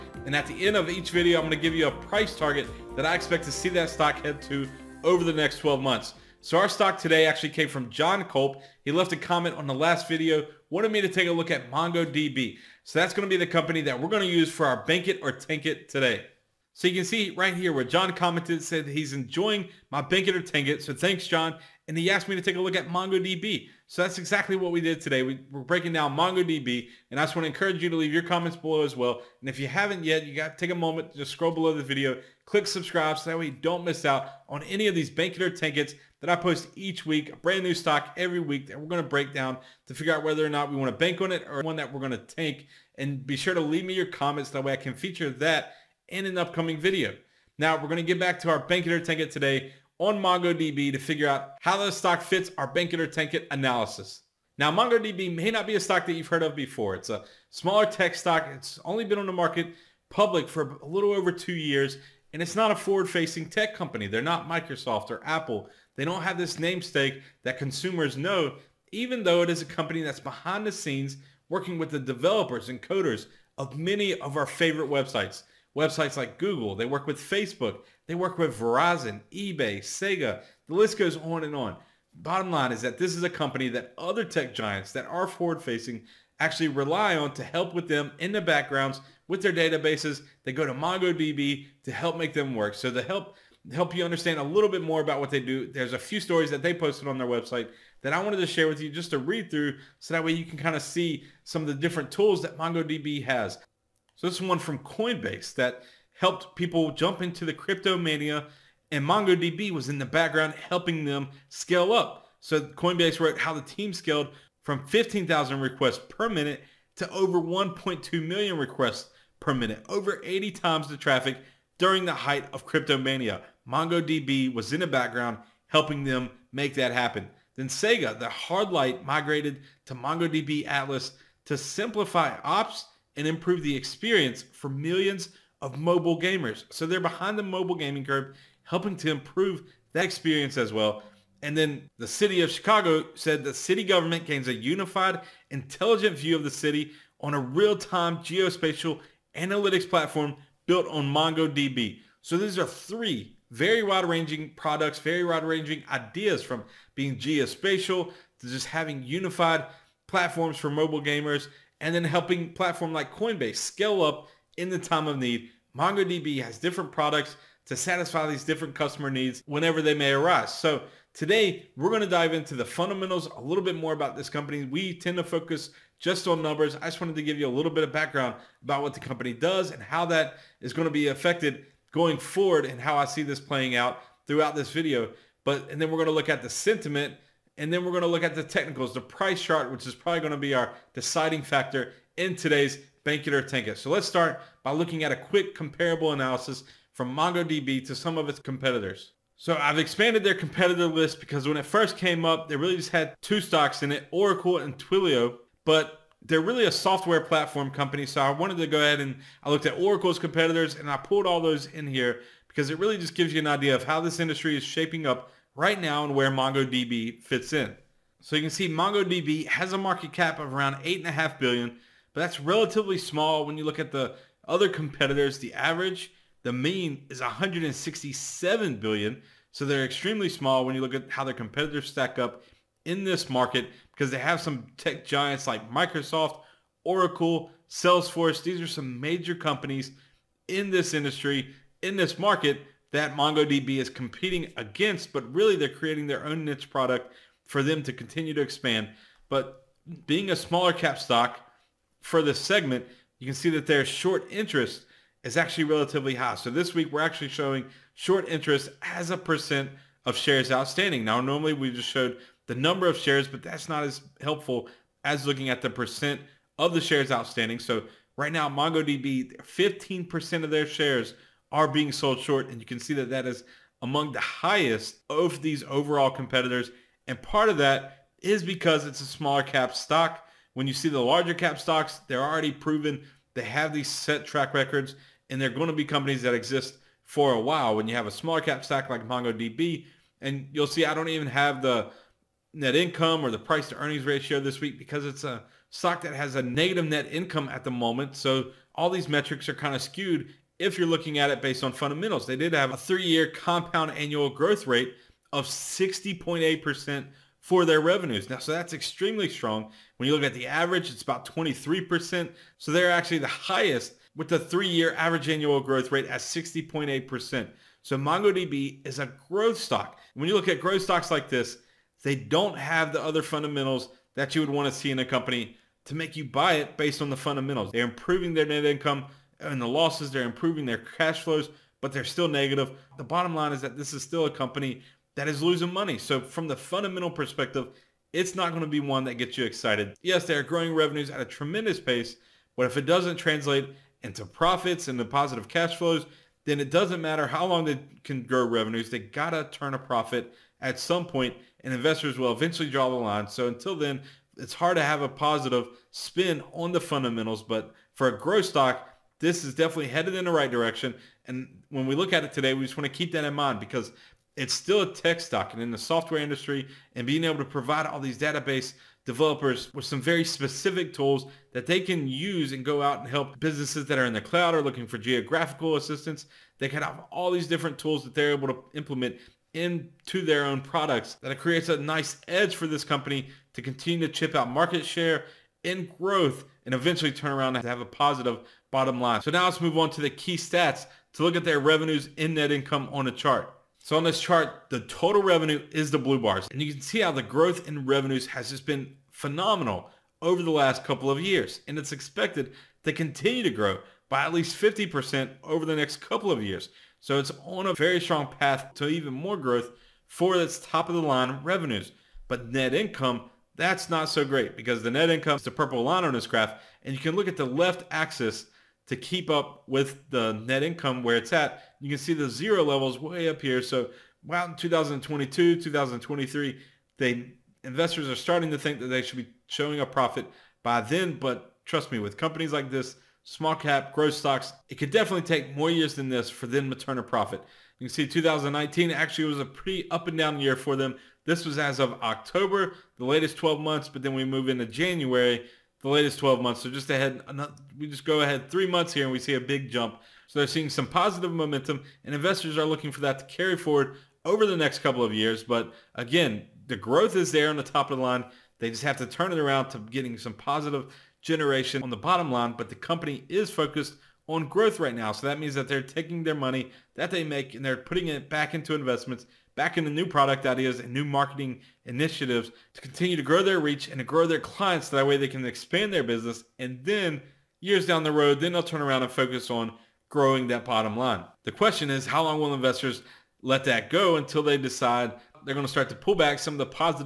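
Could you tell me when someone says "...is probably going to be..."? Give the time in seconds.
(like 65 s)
189 s.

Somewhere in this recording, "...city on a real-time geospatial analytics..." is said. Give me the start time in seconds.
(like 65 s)
146 s.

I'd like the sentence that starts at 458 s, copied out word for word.
They just have to turn it around to getting some positive generation on the bottom line.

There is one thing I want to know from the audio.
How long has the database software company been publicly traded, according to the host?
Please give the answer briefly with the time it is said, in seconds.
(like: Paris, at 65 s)
a little over two years, at 60 s.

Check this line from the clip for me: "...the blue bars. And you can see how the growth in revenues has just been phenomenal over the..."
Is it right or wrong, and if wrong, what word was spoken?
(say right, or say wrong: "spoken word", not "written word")
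right.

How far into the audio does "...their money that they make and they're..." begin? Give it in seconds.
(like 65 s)
466 s.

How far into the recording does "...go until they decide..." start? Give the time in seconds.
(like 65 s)
483 s.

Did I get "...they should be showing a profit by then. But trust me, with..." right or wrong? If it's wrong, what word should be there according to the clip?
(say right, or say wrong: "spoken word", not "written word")
right.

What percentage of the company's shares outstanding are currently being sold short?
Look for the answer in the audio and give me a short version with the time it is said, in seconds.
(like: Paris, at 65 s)
15%, at 269 s.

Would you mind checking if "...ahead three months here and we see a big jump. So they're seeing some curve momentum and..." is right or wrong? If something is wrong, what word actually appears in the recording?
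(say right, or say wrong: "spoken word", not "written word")
wrong: "positive", not "curve".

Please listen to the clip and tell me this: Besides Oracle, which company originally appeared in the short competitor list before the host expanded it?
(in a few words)
Twilio.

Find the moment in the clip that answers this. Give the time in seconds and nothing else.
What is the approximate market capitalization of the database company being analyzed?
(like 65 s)
220 s.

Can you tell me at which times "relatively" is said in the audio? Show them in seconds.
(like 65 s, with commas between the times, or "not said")
222 s, 255 s.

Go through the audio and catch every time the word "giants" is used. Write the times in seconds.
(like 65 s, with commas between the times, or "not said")
84 s, 235 s.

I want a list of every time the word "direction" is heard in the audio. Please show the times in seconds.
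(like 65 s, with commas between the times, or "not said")
360 s.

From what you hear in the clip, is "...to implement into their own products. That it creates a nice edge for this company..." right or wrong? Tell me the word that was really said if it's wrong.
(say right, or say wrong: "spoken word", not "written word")
right.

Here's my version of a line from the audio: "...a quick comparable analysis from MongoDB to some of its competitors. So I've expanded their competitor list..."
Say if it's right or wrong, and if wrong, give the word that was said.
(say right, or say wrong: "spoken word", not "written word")
right.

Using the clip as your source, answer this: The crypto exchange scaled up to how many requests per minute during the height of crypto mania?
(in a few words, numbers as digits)
1.2 million.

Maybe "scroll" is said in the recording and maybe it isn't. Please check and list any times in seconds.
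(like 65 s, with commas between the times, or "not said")
31 s.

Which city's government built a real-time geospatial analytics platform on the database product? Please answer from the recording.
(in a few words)
Chicago.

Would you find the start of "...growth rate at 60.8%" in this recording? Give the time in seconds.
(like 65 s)
315 s.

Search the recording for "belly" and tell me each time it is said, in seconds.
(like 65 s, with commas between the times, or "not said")
not said.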